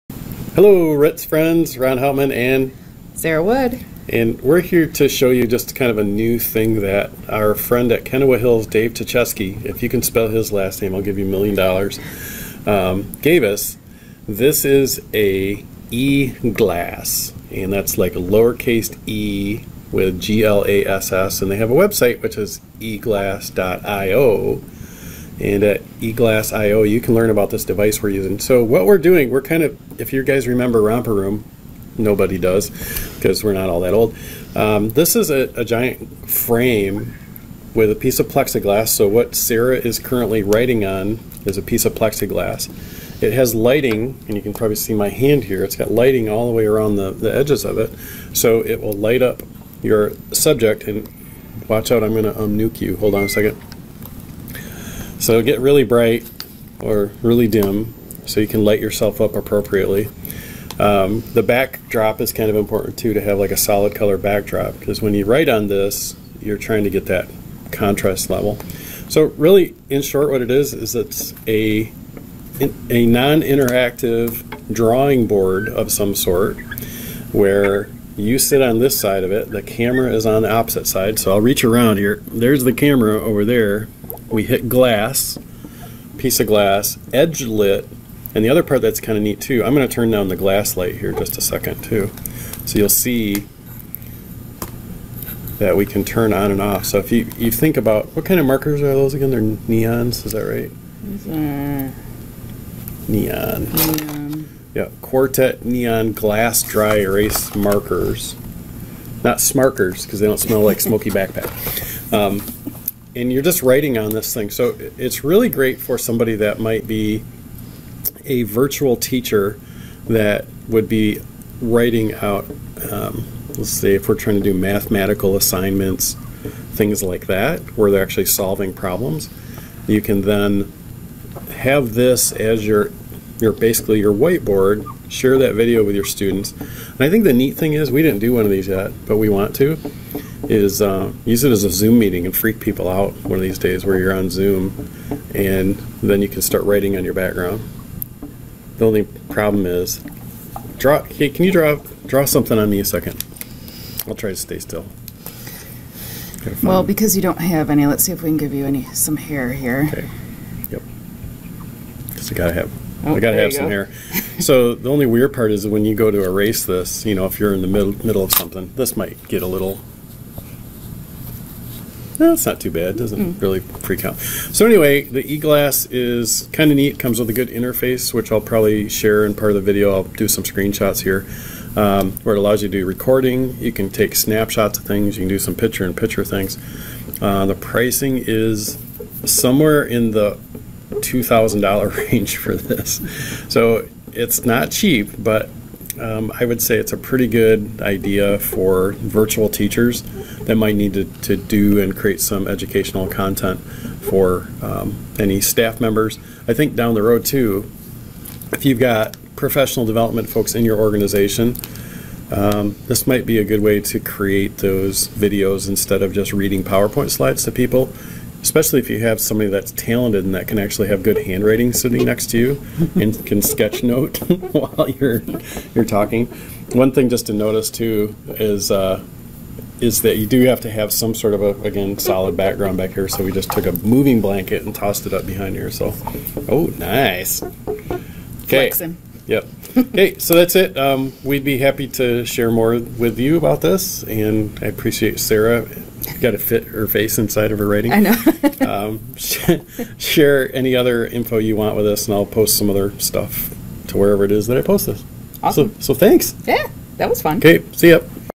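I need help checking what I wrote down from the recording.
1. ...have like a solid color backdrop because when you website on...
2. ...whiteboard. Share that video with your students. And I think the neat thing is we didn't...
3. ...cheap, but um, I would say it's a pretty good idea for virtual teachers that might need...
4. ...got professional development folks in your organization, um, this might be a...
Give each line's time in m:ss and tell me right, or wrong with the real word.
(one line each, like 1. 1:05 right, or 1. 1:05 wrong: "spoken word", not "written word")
1. 1:03 wrong: "write", not "website"
2. 2:14 right
3. 3:14 right
4. 3:28 right.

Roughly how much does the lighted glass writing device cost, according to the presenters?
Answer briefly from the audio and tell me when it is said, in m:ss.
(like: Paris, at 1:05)
$2,000, at 3:11.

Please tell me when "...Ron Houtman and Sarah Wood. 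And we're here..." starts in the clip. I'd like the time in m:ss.
0:01.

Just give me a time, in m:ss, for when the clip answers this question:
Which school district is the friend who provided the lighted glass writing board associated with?
0:08.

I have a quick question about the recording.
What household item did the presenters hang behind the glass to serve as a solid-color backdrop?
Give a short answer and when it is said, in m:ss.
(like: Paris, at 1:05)
A moving blanket, at 3:53.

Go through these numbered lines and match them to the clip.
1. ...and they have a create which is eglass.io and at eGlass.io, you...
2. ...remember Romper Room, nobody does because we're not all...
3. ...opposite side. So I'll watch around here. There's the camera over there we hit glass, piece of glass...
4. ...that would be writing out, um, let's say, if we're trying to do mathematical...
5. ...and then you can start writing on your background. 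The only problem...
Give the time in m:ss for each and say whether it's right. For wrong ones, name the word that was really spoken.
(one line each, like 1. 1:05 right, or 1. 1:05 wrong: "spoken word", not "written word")
1. 0:21 wrong: "website", not "create"
2. 0:30 right
3. 1:20 wrong: "reach", not "watch"
4. 2:00 right
5. 2:25 right.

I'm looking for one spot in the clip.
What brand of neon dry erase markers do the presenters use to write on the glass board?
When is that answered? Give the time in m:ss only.
1:45.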